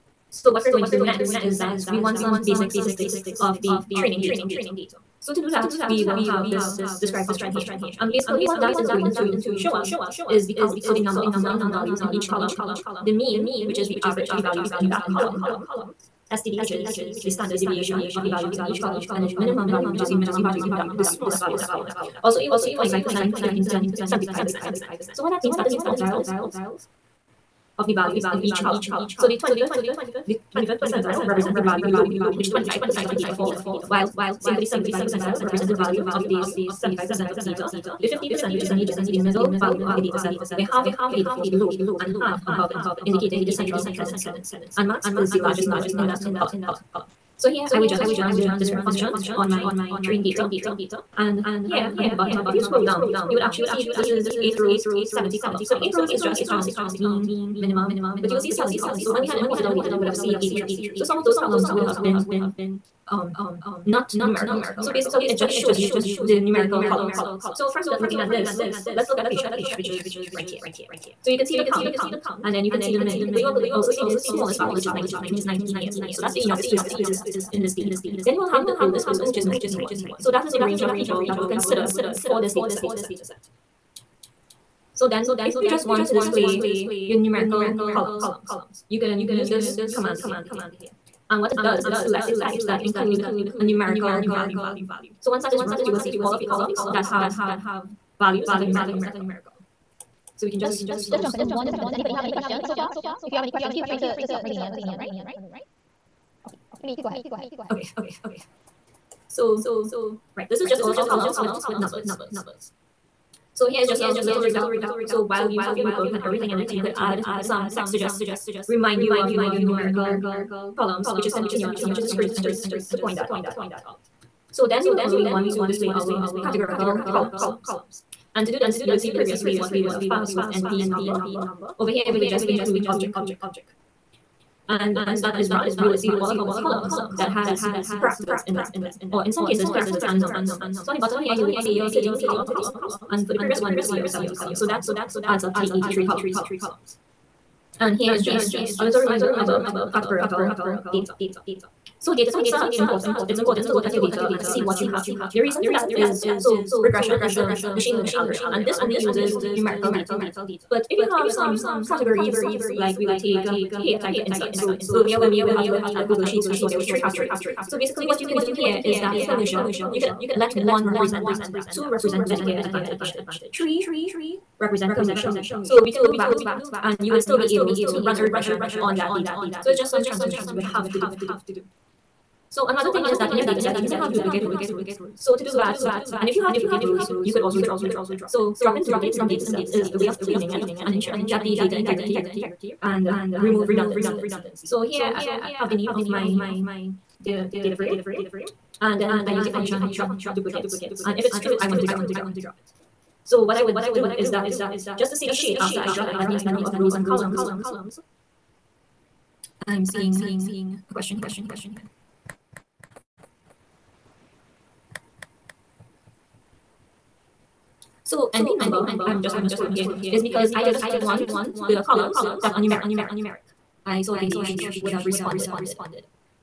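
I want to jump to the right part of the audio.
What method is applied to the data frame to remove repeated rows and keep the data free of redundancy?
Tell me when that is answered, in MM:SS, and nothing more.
03:19.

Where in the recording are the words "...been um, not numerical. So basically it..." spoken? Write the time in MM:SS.
01:02.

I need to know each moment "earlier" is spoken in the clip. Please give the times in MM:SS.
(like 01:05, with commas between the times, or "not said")
02:44.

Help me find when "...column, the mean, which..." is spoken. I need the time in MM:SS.
00:12.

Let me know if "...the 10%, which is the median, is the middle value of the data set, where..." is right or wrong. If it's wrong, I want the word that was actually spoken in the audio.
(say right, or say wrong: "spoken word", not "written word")
wrong: "50", not "10".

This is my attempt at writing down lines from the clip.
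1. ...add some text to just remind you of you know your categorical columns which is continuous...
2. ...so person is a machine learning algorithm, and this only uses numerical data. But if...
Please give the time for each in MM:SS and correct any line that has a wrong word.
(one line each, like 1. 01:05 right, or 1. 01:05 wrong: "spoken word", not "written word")
1. 01:56 wrong: "numerical", not "categorical"
2. 02:36 wrong: "regression", not "person".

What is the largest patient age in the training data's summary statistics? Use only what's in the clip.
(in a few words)
91.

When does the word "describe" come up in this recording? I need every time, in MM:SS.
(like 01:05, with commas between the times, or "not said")
00:07, 00:48.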